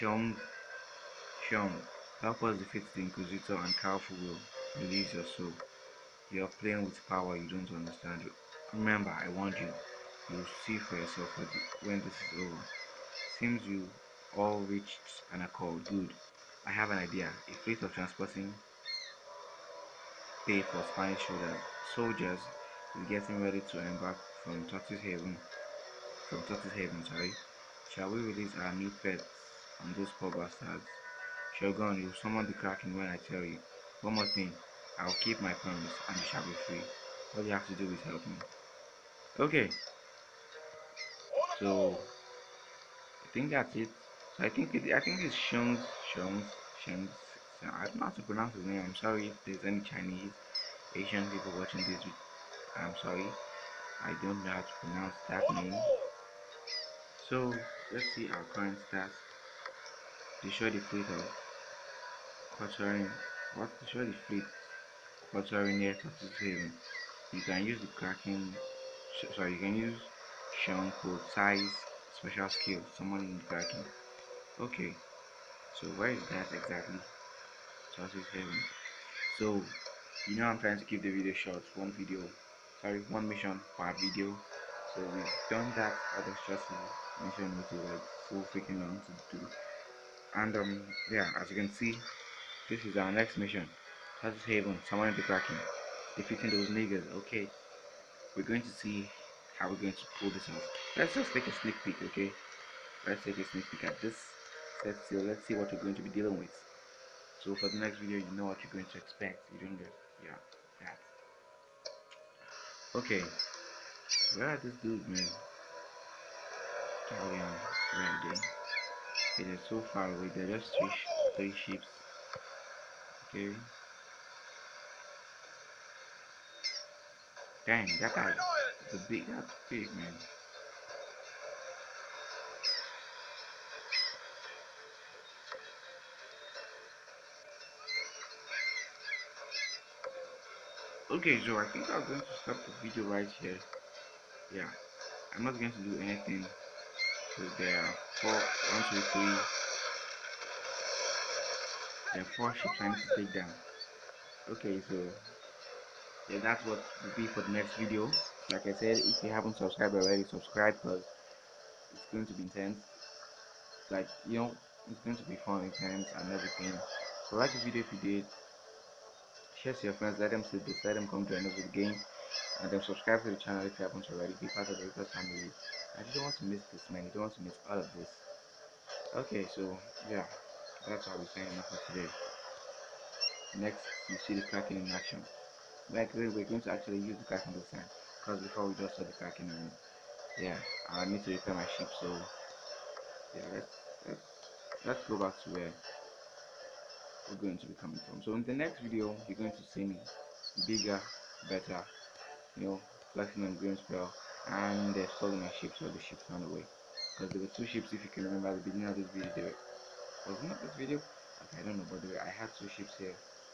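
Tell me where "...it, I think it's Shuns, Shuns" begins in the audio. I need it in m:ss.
0:44.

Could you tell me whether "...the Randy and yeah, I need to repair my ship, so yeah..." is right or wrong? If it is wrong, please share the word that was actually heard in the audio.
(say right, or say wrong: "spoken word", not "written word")
wrong: "Kraken", not "Randy".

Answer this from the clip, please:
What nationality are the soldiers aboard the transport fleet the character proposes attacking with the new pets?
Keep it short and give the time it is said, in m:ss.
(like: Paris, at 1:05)
Spanish, at 0:20.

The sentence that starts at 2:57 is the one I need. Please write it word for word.
You don't want to miss all of this.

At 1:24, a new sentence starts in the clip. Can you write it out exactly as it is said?
So we've done that other stressful mission which is like so freaking long to do.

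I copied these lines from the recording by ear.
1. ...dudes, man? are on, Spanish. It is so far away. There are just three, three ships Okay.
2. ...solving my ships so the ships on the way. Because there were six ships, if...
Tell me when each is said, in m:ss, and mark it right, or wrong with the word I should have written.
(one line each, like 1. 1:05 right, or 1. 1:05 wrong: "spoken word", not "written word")
1. 1:54 wrong: "Randy", not "Spanish"
2. 3:25 wrong: "two", not "six".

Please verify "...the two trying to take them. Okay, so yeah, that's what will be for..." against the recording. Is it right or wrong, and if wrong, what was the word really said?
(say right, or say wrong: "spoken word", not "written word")
wrong: "four", not "two".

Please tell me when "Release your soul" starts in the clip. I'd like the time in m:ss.
0:04.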